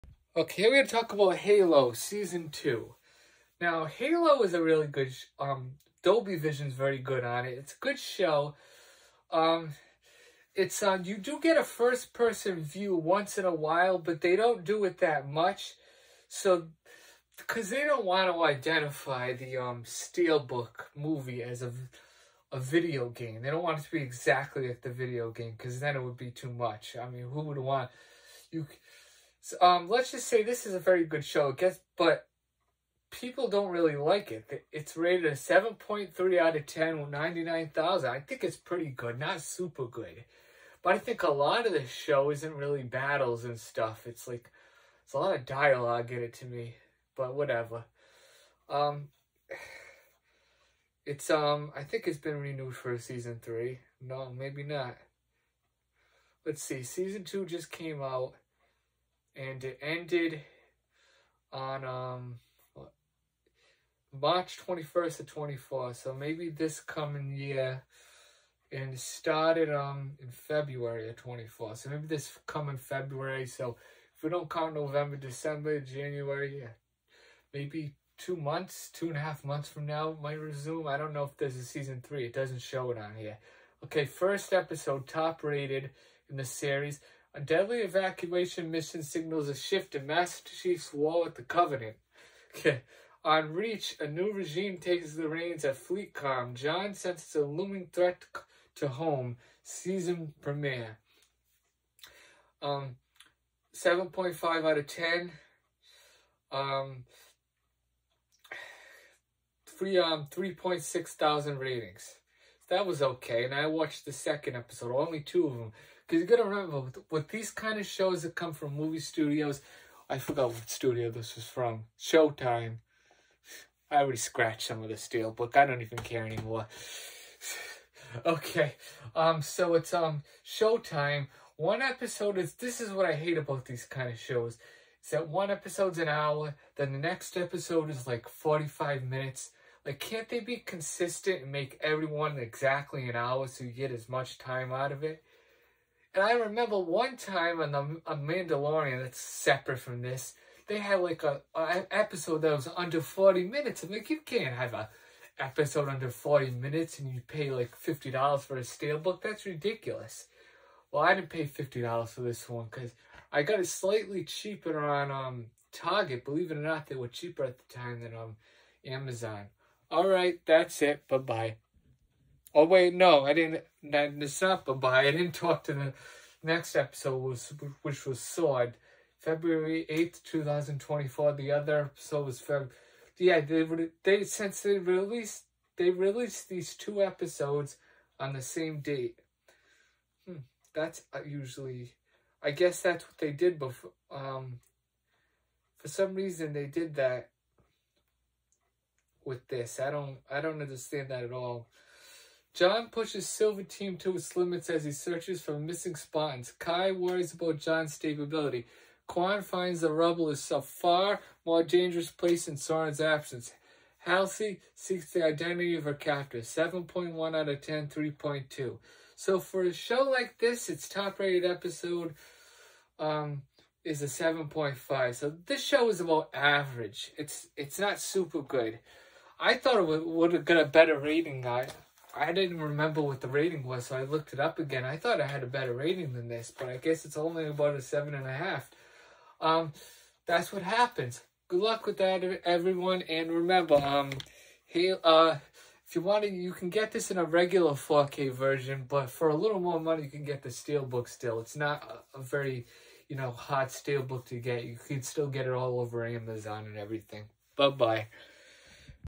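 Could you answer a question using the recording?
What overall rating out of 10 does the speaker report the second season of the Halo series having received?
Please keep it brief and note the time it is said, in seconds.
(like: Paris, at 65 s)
7.3, at 35 s.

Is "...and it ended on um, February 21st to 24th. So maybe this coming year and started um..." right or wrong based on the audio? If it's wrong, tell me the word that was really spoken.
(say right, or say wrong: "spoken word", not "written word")
wrong: "March", not "February".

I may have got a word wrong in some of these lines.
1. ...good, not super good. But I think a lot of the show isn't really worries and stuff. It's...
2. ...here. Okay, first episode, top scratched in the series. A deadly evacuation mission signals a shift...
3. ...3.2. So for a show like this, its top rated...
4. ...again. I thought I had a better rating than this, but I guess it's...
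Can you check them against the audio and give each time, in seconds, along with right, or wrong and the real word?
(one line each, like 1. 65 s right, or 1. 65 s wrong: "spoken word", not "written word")
1. 38 s wrong: "battles", not "worries"
2. 83 s wrong: "rated", not "scratched"
3. 217 s right
4. 234 s right.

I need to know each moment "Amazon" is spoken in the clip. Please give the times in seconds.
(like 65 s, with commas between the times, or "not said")
168 s, 256 s.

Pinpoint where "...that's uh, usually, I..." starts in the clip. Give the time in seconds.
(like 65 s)
190 s.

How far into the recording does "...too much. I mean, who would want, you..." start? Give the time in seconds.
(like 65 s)
26 s.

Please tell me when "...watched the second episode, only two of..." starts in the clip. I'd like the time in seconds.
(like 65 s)
113 s.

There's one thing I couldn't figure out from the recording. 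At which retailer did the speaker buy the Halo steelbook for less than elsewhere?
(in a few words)
Target.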